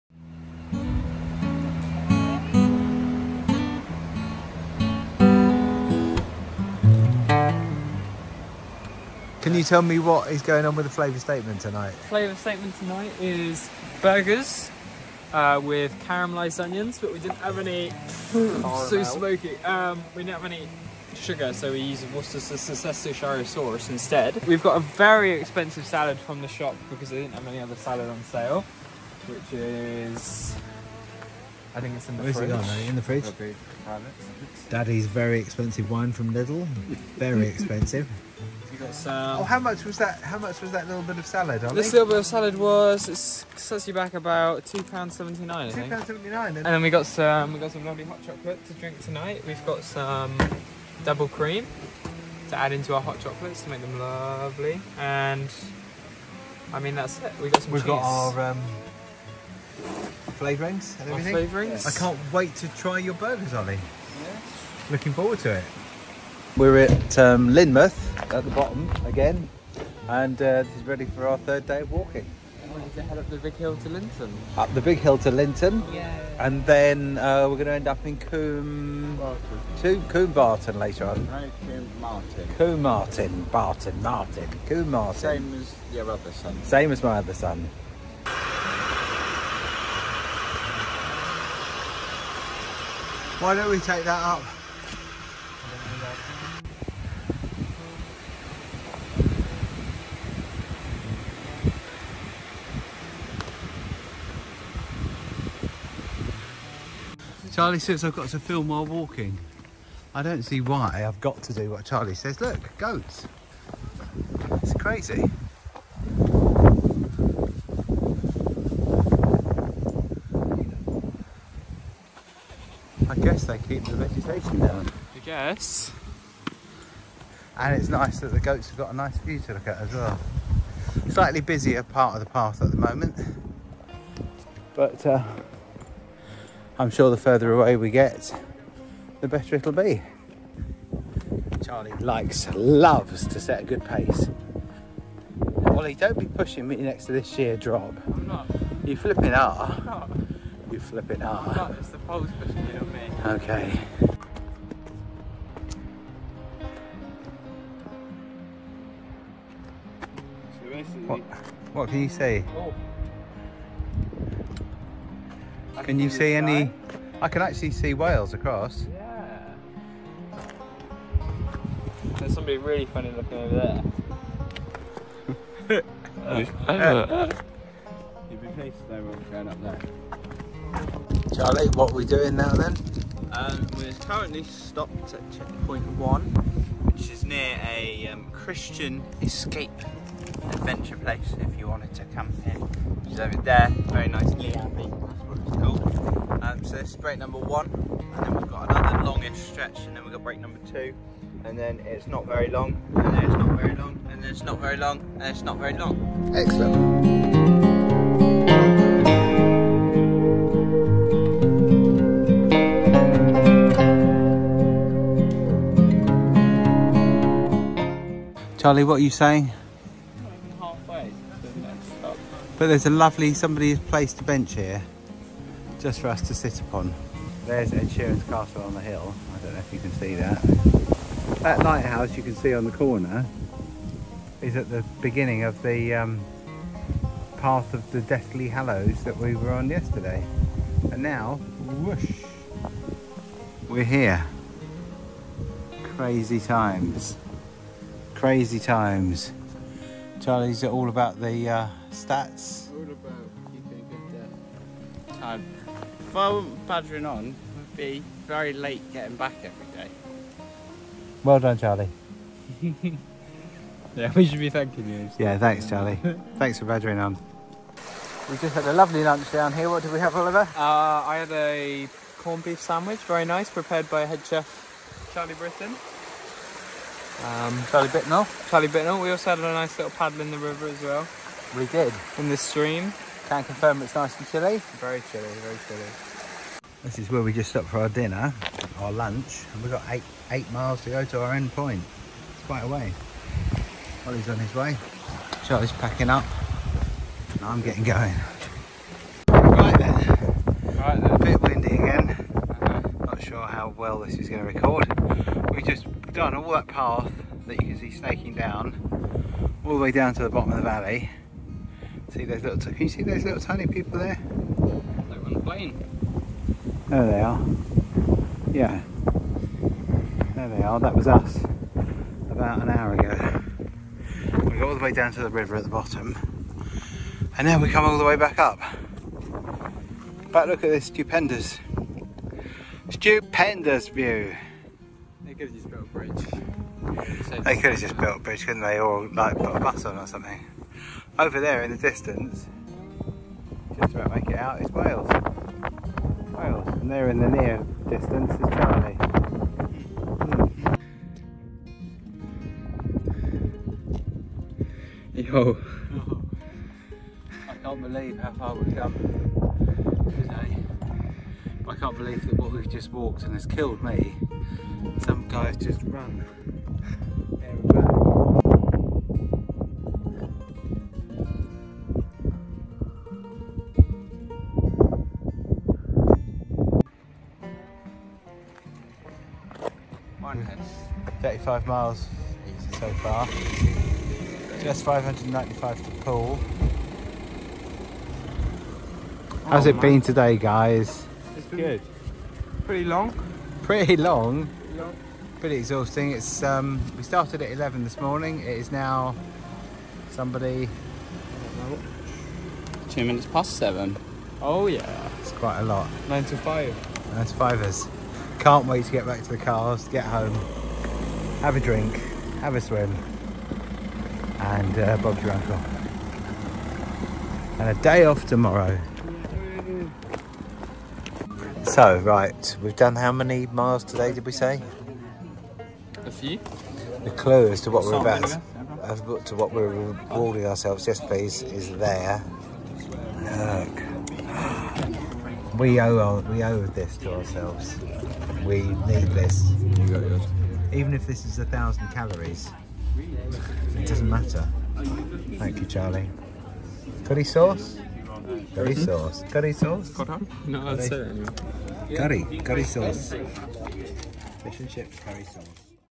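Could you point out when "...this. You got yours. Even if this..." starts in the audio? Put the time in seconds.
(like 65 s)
439 s.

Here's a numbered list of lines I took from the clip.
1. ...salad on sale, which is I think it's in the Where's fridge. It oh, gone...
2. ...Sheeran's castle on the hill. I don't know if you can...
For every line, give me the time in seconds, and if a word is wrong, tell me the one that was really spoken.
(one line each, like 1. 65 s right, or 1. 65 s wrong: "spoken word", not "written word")
1. 27 s right
2. 227 s right.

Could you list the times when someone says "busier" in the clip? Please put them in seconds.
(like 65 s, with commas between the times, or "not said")
131 s.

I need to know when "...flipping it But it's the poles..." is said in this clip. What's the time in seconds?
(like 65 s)
150 s.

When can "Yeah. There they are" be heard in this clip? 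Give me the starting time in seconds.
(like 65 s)
318 s.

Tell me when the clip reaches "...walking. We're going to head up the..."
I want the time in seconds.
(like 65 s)
71 s.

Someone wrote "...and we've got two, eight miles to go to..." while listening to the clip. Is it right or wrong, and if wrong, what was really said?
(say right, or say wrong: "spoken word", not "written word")
wrong: "eight", not "two".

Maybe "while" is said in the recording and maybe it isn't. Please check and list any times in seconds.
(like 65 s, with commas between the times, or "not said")
108 s.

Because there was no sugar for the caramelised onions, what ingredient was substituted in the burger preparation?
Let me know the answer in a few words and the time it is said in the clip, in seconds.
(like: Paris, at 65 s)
Worcestershire sauce, at 22 s.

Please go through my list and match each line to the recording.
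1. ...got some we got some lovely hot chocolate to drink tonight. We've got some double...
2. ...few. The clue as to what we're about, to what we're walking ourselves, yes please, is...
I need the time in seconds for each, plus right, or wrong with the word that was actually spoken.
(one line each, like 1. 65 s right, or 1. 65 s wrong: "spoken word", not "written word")
1. 46 s right
2. 426 s wrong: "rewarding", not "walking".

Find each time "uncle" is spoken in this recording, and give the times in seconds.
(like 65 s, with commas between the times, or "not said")
415 s.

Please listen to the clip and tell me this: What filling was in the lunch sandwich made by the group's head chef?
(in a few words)
Corned beef.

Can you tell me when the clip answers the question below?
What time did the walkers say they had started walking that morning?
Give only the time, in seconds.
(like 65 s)
397 s.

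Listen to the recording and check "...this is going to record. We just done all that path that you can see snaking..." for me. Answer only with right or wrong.
right.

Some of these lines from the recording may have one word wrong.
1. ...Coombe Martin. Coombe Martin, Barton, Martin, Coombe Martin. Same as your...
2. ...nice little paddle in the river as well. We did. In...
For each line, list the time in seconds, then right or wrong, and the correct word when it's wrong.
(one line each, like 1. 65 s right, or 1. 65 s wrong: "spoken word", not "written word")
1. 81 s right
2. 279 s right.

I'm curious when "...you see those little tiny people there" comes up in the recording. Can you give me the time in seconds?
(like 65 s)
312 s.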